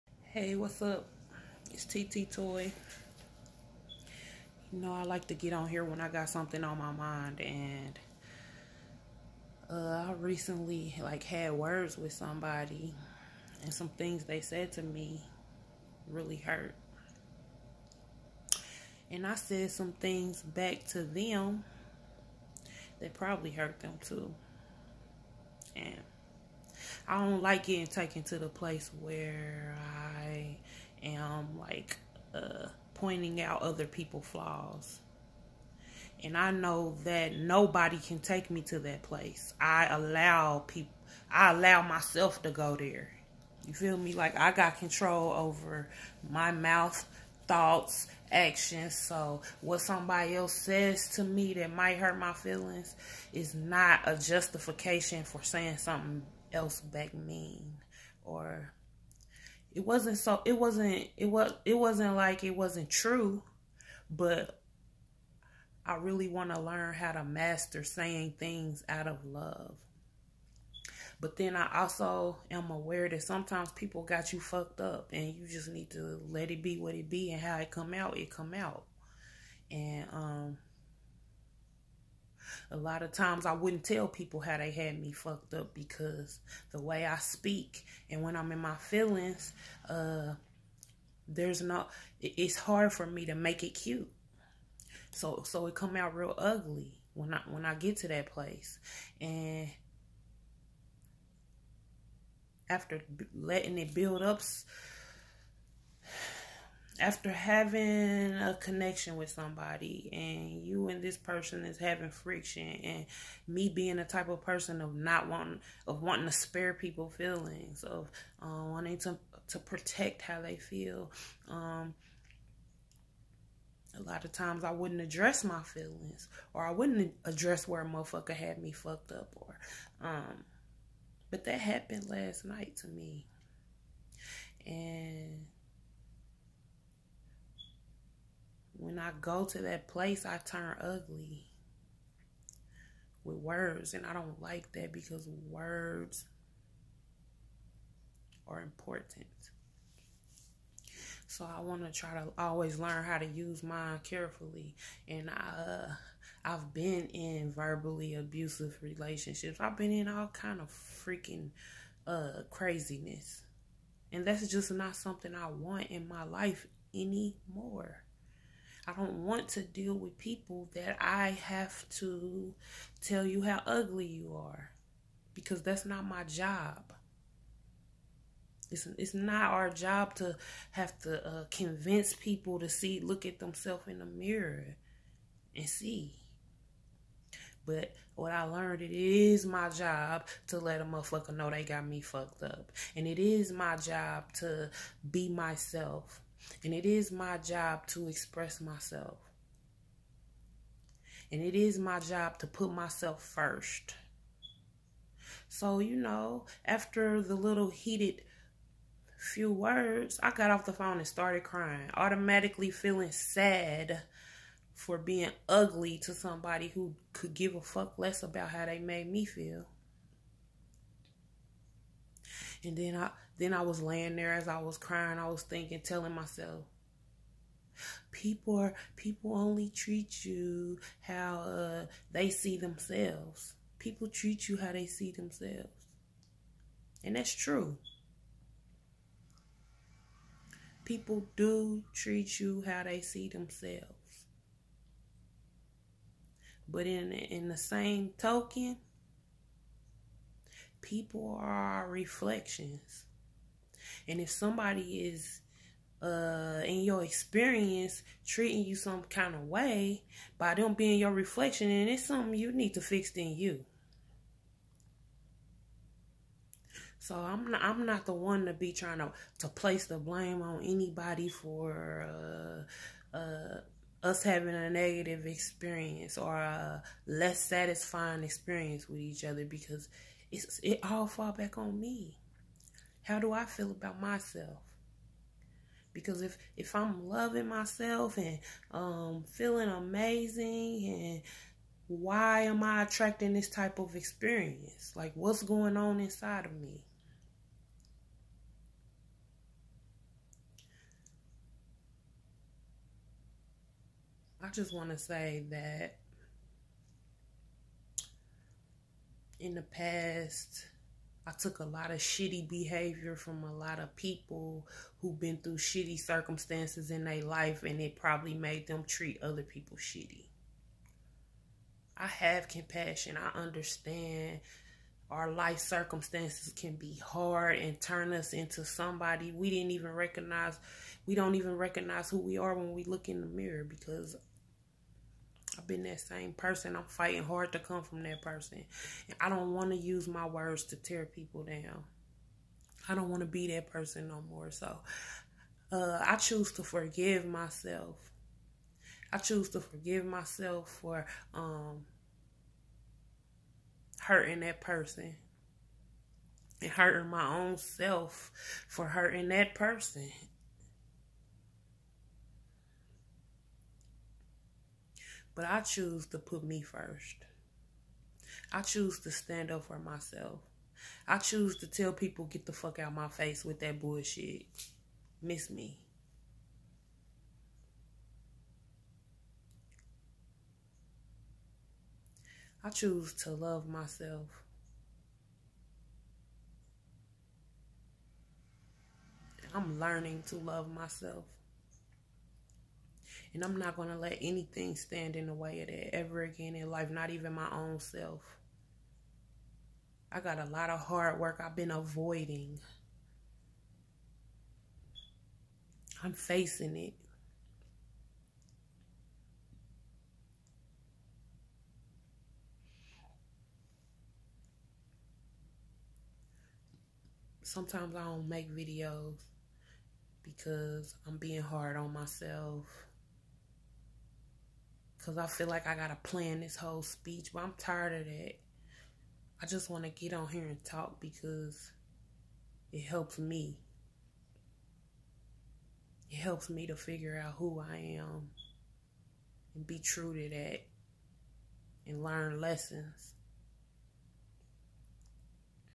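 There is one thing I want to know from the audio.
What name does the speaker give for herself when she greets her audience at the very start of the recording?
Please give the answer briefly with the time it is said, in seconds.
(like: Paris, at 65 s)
TT Toy, at 1 s.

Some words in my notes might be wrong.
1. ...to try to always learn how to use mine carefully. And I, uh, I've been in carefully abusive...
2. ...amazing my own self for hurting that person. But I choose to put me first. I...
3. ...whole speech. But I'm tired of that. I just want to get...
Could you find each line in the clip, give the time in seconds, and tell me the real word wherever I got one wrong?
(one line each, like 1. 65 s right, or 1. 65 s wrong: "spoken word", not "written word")
1. 151 s wrong: "verbally", not "carefully"
2. 356 s wrong: "hurting", not "amazing"
3. 426 s right.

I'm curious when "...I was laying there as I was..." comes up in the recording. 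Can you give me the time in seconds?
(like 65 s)
223 s.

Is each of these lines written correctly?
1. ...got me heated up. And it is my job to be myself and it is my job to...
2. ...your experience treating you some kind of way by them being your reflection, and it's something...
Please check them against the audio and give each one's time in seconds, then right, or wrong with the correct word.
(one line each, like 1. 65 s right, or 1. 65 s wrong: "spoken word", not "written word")
1. 191 s wrong: "fucked", not "heated"
2. 256 s right.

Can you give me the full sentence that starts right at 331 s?
We don't even recognize who we are when we look in the mirror because I've been that same person.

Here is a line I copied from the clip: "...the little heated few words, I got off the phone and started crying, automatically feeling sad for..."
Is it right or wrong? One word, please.
right.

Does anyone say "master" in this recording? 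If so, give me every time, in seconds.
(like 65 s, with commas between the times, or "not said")
67 s.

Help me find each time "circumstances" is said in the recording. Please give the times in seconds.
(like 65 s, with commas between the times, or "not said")
315 s, 325 s.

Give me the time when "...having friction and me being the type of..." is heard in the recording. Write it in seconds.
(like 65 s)
111 s.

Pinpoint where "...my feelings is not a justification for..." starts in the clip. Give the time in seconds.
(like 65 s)
52 s.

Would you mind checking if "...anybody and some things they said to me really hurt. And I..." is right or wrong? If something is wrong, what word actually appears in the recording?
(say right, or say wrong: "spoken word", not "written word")
wrong: "somebody", not "anybody".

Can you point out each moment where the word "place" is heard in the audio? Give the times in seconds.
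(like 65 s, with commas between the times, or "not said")
28 s, 39 s, 98 s, 139 s, 269 s.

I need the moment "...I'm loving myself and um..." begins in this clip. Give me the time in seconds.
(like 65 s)
286 s.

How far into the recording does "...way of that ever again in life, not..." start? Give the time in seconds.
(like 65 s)
395 s.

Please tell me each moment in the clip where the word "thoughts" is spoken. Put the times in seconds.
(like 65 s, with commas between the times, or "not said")
47 s.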